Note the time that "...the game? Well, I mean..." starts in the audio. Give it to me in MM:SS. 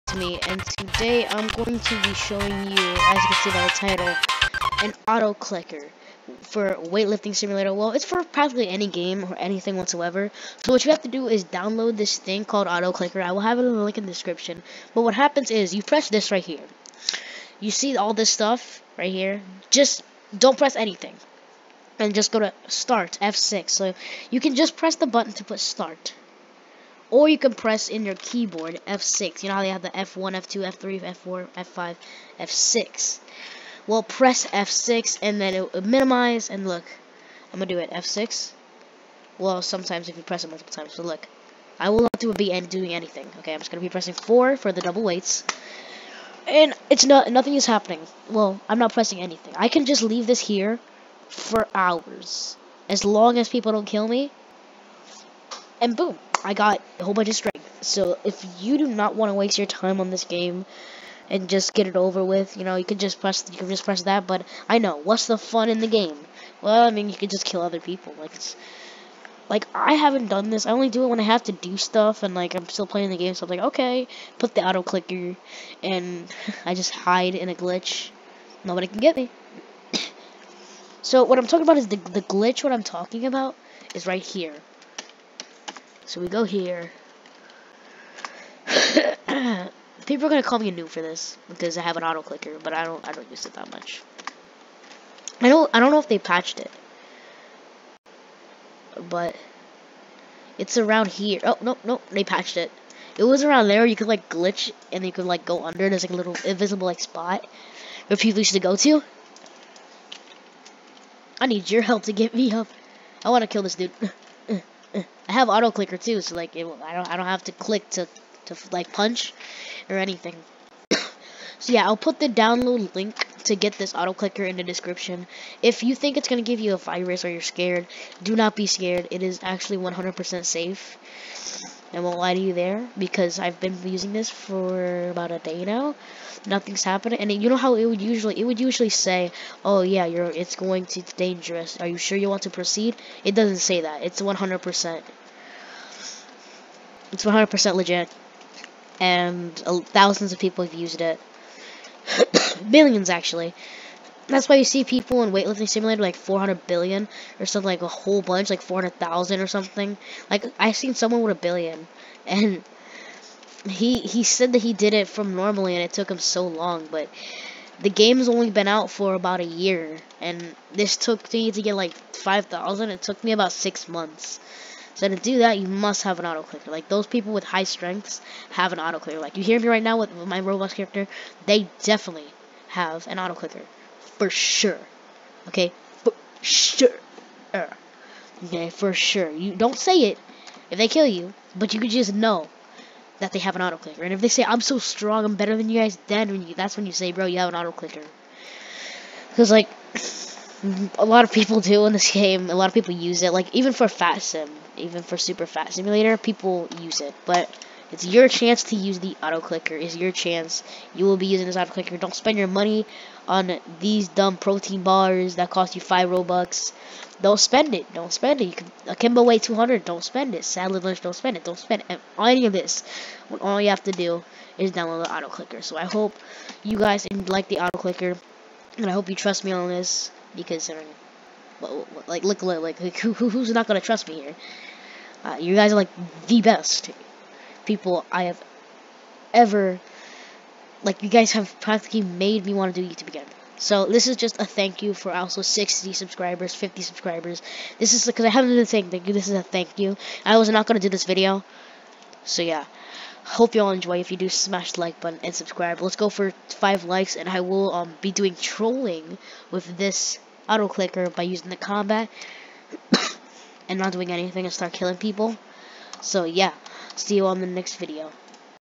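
01:05.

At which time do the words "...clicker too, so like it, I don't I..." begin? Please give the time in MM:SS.
01:55.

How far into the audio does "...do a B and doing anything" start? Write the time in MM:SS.
00:42.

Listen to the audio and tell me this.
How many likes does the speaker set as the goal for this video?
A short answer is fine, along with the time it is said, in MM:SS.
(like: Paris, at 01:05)
5, at 04:16.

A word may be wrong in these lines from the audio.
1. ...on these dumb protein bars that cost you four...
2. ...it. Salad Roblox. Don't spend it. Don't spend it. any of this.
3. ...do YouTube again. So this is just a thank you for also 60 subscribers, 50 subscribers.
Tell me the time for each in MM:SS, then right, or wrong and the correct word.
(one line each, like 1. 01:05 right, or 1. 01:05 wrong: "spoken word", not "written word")
1. 03:33 wrong: "five", not "four"
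2. 03:40 wrong: "Lunch", not "Roblox"
3. 04:02 right.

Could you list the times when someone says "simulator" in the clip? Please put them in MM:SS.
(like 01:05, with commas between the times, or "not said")
00:07, 02:35, 03:25.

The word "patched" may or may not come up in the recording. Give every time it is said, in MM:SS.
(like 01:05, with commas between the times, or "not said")
01:36, 01:42.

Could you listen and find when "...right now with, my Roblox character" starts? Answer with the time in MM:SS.
02:59.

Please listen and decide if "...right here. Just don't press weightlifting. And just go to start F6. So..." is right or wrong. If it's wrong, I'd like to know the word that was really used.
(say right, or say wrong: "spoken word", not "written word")
wrong: "anything", not "weightlifting".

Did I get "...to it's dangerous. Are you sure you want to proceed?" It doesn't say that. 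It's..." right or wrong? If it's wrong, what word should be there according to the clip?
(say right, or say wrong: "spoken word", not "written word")
right.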